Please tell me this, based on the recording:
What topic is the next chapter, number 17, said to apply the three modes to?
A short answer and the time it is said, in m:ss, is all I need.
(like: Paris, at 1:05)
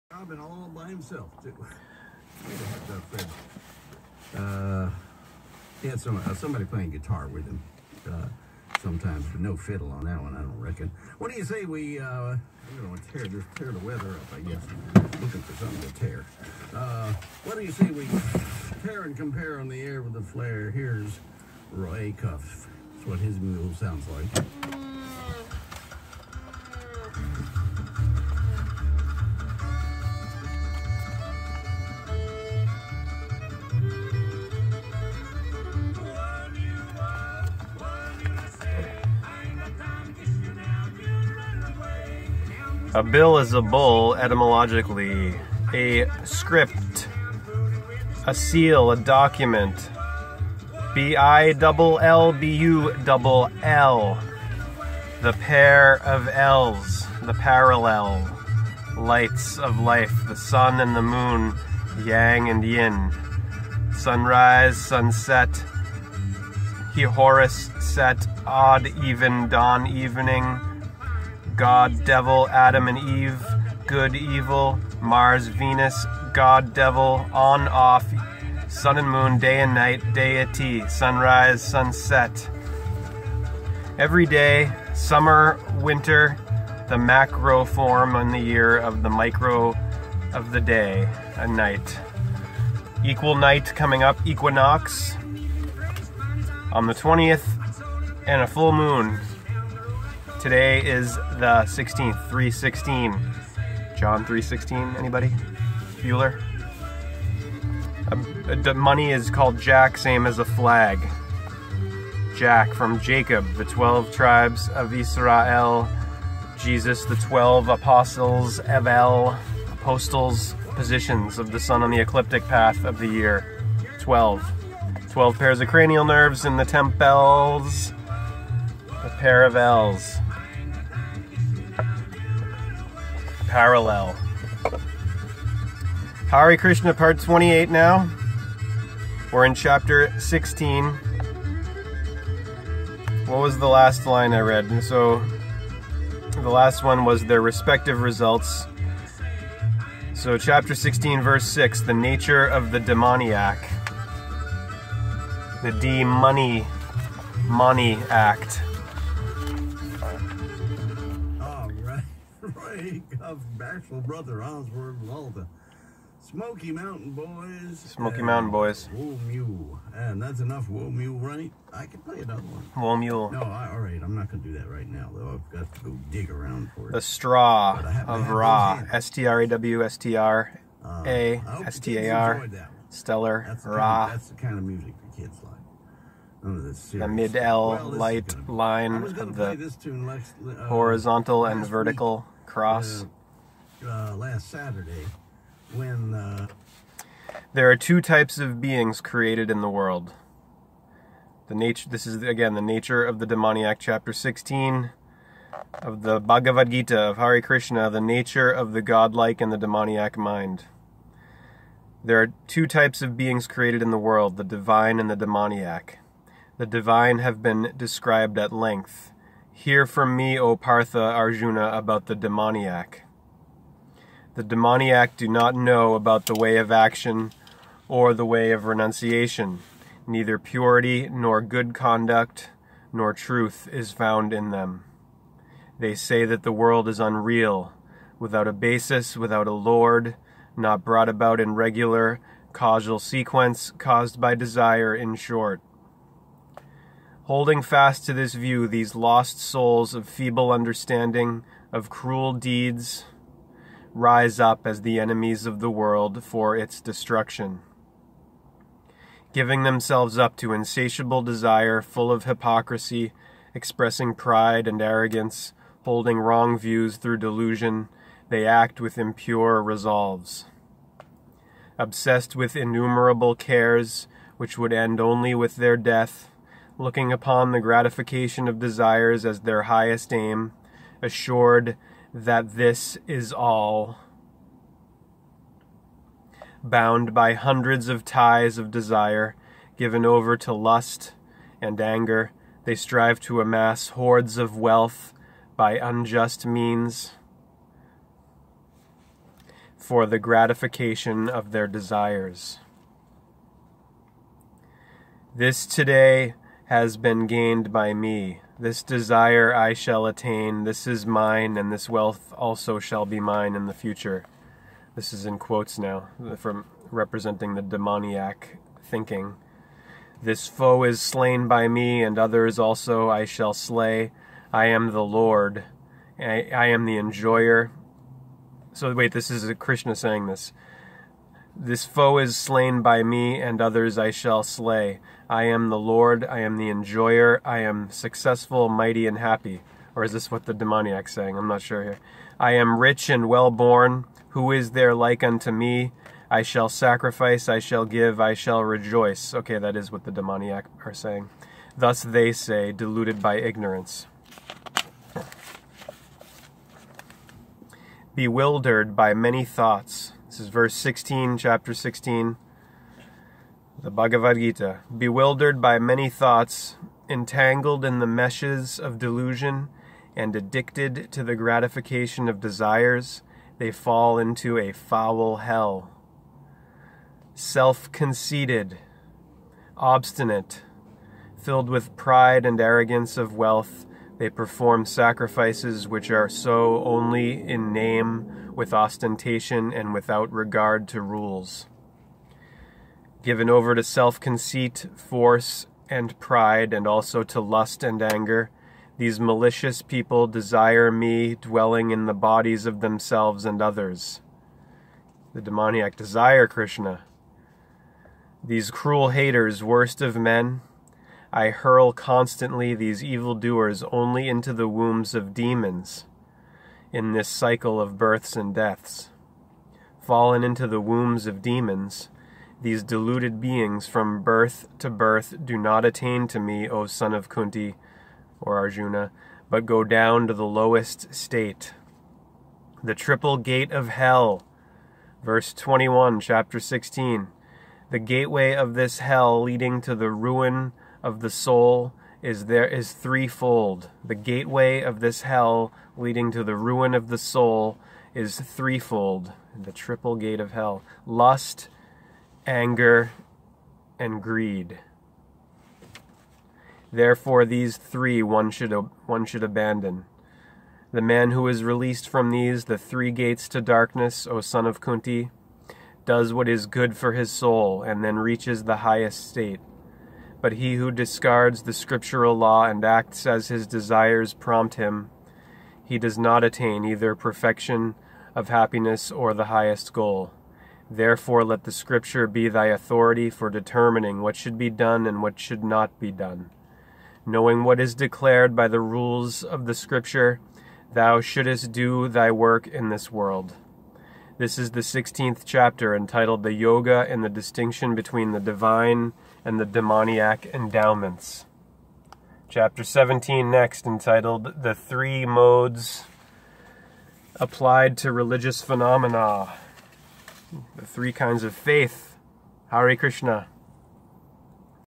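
Religious Phenomena, at 8:24.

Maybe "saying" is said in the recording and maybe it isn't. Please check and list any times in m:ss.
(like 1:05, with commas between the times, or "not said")
5:29, 5:41, 5:50.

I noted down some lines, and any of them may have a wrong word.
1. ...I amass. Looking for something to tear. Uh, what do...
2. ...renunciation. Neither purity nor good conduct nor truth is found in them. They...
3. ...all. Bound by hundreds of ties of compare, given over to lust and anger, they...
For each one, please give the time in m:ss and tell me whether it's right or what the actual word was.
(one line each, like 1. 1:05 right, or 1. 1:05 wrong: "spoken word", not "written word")
1. 0:14 wrong: "guess", not "amass"
2. 3:48 right
3. 4:43 wrong: "desire", not "compare".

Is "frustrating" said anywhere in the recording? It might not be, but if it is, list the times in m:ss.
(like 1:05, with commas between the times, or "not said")
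not said.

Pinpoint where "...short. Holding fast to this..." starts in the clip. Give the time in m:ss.
4:05.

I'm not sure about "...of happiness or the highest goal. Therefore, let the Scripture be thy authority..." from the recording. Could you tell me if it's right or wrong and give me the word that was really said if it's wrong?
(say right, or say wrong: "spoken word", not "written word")
right.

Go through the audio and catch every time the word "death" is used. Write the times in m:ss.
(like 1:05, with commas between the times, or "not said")
4:35, 6:58.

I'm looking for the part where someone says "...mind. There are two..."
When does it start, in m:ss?
3:30.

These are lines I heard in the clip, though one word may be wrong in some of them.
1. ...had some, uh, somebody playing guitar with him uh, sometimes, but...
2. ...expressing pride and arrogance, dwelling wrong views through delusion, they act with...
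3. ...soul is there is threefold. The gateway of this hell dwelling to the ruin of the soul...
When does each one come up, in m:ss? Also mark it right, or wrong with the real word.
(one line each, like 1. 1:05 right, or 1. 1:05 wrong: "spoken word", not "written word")
1. 0:05 right
2. 4:23 wrong: "holding", not "dwelling"
3. 7:21 wrong: "leading", not "dwelling".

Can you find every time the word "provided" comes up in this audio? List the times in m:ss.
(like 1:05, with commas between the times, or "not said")
not said.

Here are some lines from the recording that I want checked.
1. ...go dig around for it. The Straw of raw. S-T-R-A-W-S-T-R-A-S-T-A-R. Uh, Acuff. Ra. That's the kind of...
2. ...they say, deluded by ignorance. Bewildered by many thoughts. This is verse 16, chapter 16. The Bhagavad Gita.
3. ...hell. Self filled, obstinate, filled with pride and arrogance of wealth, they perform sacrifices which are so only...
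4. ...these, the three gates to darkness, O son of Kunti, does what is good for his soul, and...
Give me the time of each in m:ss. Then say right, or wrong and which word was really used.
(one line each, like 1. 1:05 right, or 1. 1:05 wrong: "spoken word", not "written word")
1. 2:55 wrong: "Stellar", not "Acuff"
2. 5:52 right
3. 6:15 wrong: "conceited", not "filled"
4. 7:42 right.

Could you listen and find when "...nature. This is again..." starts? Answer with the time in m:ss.
3:21.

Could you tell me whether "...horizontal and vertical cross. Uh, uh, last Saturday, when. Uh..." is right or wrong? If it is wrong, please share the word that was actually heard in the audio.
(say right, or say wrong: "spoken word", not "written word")
right.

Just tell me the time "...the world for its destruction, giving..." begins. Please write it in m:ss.
4:15.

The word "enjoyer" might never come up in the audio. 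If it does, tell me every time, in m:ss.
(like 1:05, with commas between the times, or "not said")
5:26, 5:36.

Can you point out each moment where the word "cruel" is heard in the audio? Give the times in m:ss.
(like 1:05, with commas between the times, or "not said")
4:11, 6:48.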